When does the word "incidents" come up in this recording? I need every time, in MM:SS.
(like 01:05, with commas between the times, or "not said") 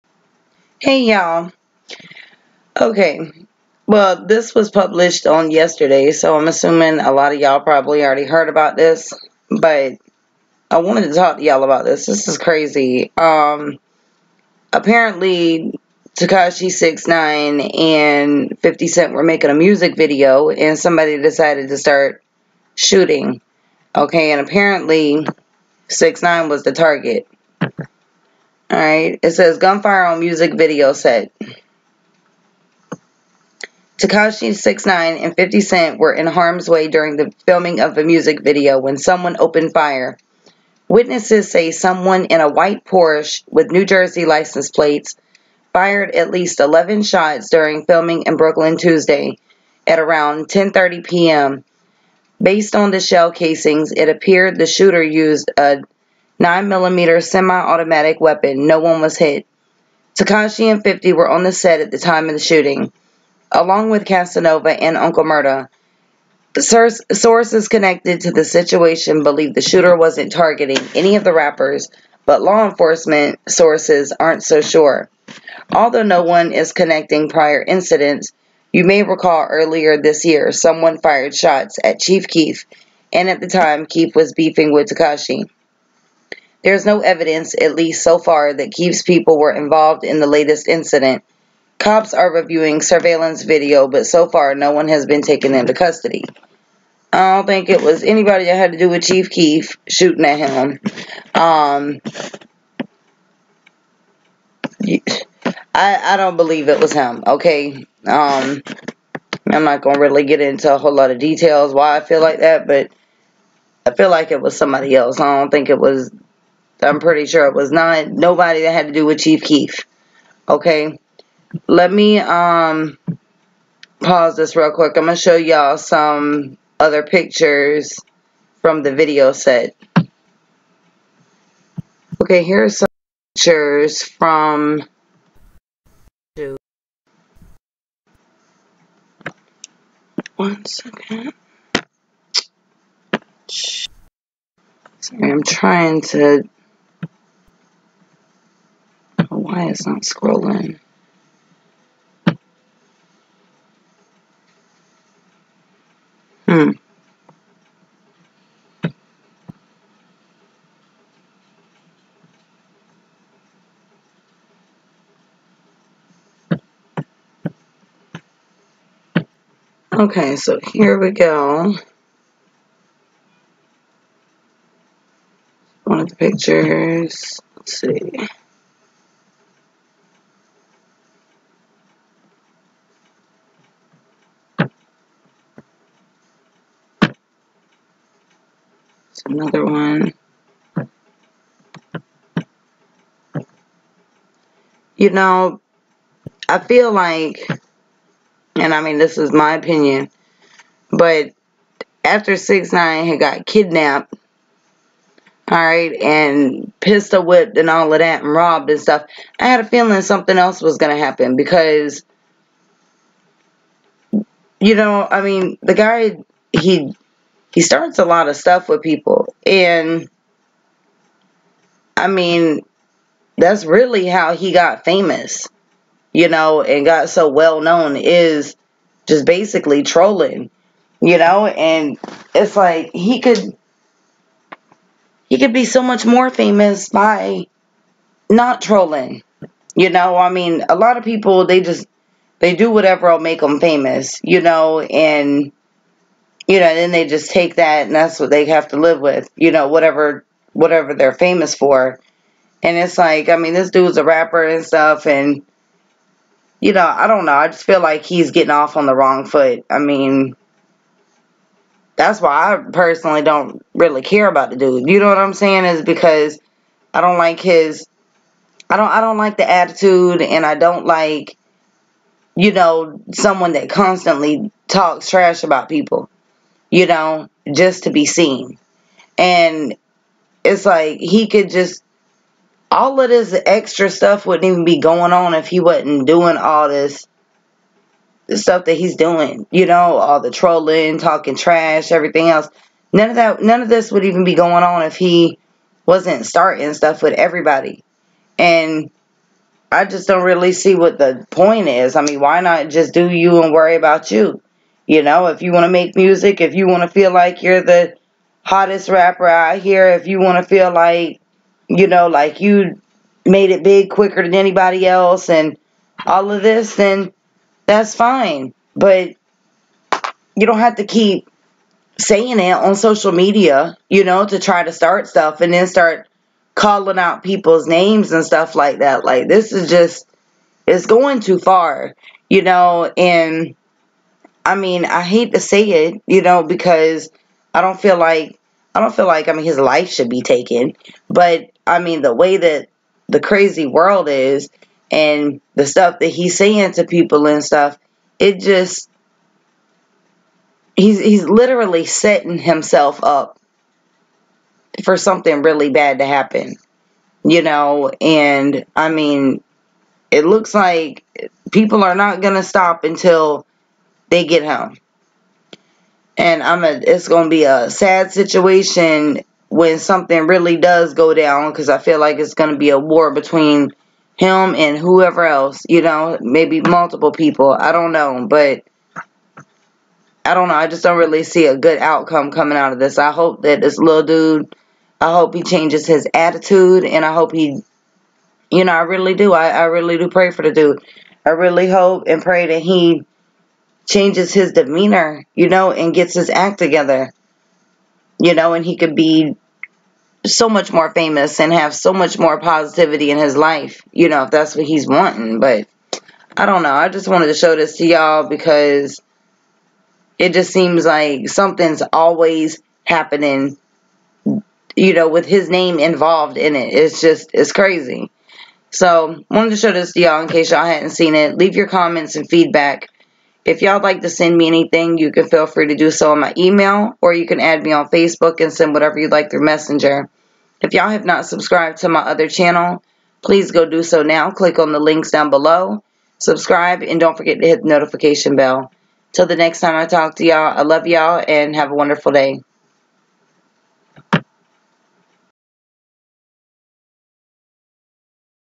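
01:17, 01:30.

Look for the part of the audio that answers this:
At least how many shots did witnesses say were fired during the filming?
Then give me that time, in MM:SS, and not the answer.
00:46.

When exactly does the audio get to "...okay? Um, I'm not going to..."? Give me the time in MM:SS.
01:47.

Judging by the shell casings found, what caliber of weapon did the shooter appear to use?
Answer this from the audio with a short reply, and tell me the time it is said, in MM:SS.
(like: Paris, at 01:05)
9 millimeter, at 00:56.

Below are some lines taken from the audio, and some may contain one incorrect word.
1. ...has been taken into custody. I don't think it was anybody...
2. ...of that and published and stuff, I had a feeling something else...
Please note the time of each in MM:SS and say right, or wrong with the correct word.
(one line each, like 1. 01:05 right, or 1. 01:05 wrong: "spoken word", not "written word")
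1. 01:34 right
2. 03:27 wrong: "robbed", not "published".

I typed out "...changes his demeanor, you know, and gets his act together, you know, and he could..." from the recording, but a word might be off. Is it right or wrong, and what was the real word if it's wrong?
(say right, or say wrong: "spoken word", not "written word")
right.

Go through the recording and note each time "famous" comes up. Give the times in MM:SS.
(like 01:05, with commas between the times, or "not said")
03:44, 03:56, 04:03, 04:11, 06:40.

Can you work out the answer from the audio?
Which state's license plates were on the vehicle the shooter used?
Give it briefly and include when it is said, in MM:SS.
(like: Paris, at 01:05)
New Jersey, at 00:43.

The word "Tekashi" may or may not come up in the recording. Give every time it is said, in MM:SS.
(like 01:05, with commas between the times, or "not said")
00:16, 00:33, 01:00, 01:24.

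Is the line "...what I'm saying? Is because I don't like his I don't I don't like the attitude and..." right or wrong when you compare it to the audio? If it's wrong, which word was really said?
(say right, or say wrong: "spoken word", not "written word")
right.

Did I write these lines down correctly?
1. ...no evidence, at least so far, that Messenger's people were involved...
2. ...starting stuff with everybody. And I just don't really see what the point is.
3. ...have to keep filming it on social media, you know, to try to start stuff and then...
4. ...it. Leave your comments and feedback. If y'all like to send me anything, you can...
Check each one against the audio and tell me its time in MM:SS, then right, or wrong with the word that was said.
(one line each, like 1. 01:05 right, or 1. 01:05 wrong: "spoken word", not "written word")
1. 01:26 wrong: "Keef", not "Messenger"
2. 04:56 right
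3. 05:20 wrong: "saying", not "filming"
4. 07:01 right.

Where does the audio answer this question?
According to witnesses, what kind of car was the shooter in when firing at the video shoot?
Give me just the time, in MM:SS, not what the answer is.
00:42.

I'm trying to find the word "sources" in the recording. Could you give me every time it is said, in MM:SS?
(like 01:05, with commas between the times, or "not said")
01:07, 01:13.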